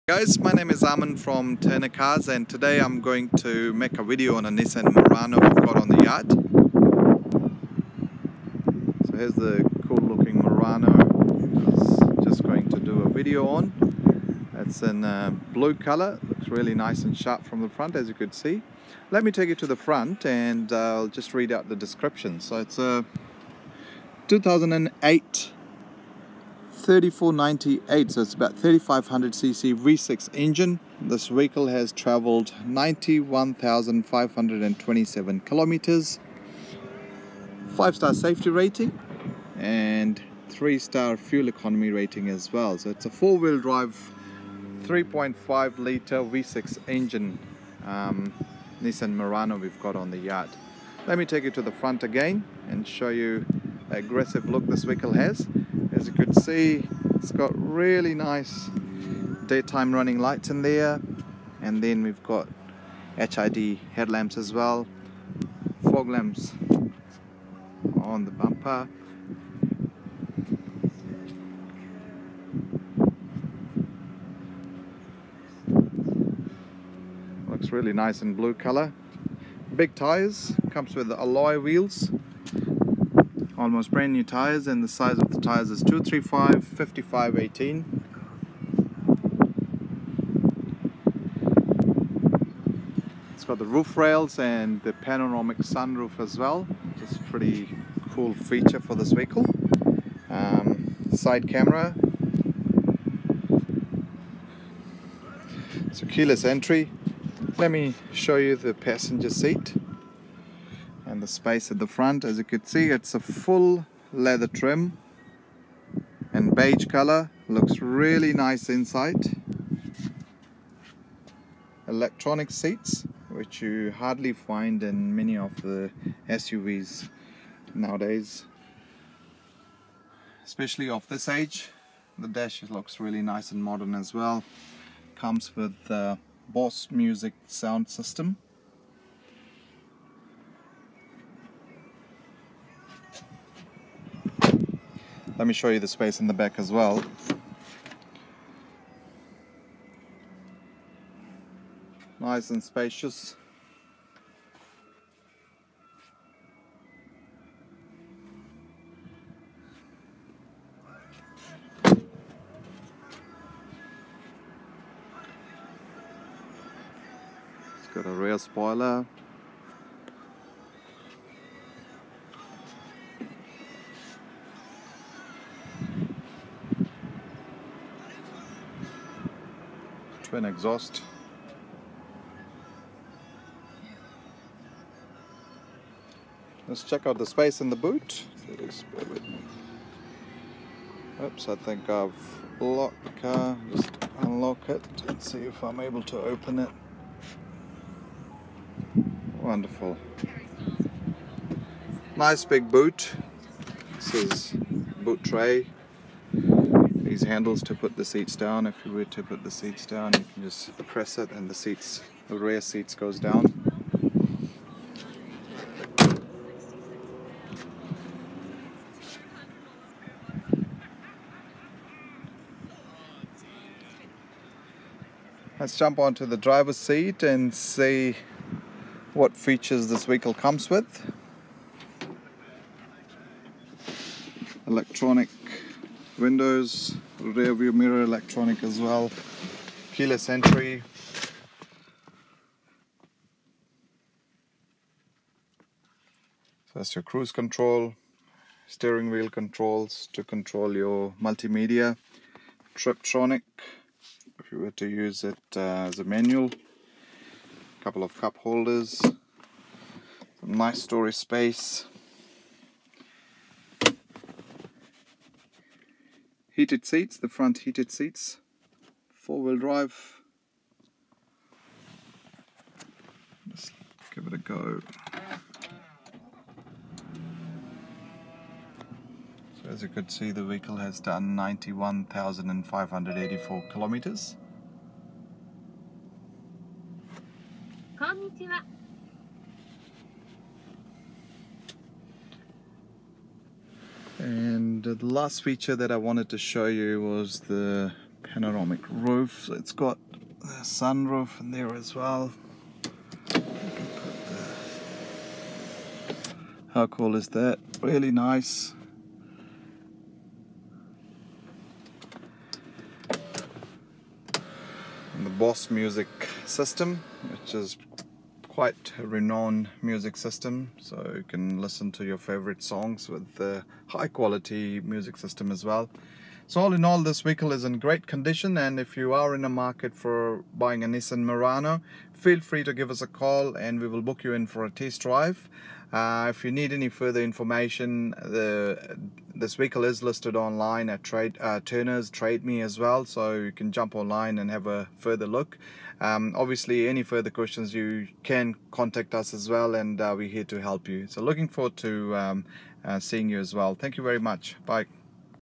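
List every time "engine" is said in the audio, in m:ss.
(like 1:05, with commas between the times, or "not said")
0:30, 0:46.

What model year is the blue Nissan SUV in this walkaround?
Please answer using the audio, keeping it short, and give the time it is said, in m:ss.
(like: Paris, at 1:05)
2008, at 0:24.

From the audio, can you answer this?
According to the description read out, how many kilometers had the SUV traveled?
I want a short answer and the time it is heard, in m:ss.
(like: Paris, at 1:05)
91527, at 0:32.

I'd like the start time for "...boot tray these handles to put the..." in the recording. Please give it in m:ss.
3:25.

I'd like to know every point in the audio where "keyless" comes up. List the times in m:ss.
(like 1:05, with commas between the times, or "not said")
1:46, 3:59.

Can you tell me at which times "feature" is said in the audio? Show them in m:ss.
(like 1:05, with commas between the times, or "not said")
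1:38, 3:49, 4:55.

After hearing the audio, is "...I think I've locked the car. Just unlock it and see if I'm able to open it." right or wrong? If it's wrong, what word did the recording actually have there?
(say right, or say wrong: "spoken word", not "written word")
right.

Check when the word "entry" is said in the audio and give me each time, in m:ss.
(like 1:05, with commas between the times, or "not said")
1:46, 4:00.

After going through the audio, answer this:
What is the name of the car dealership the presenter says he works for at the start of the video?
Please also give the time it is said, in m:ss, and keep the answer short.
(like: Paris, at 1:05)
Turner Cars, at 0:01.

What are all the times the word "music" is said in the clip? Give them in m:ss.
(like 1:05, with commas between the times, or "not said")
2:16, 5:15, 5:19, 5:24.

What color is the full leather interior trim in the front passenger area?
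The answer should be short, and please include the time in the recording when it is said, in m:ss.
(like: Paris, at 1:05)
beige, at 1:56.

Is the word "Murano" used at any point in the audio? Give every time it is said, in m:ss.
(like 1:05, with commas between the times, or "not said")
0:04, 0:10, 0:49, 5:31.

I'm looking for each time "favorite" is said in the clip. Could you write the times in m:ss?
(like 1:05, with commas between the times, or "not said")
5:22.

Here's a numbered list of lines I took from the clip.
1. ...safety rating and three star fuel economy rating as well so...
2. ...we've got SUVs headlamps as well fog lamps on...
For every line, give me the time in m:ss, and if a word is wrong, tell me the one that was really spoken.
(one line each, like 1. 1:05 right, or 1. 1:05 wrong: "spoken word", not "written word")
1. 0:38 right
2. 1:02 wrong: "HID", not "SUVs".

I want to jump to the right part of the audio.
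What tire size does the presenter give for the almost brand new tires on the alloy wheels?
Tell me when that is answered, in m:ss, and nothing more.
1:25.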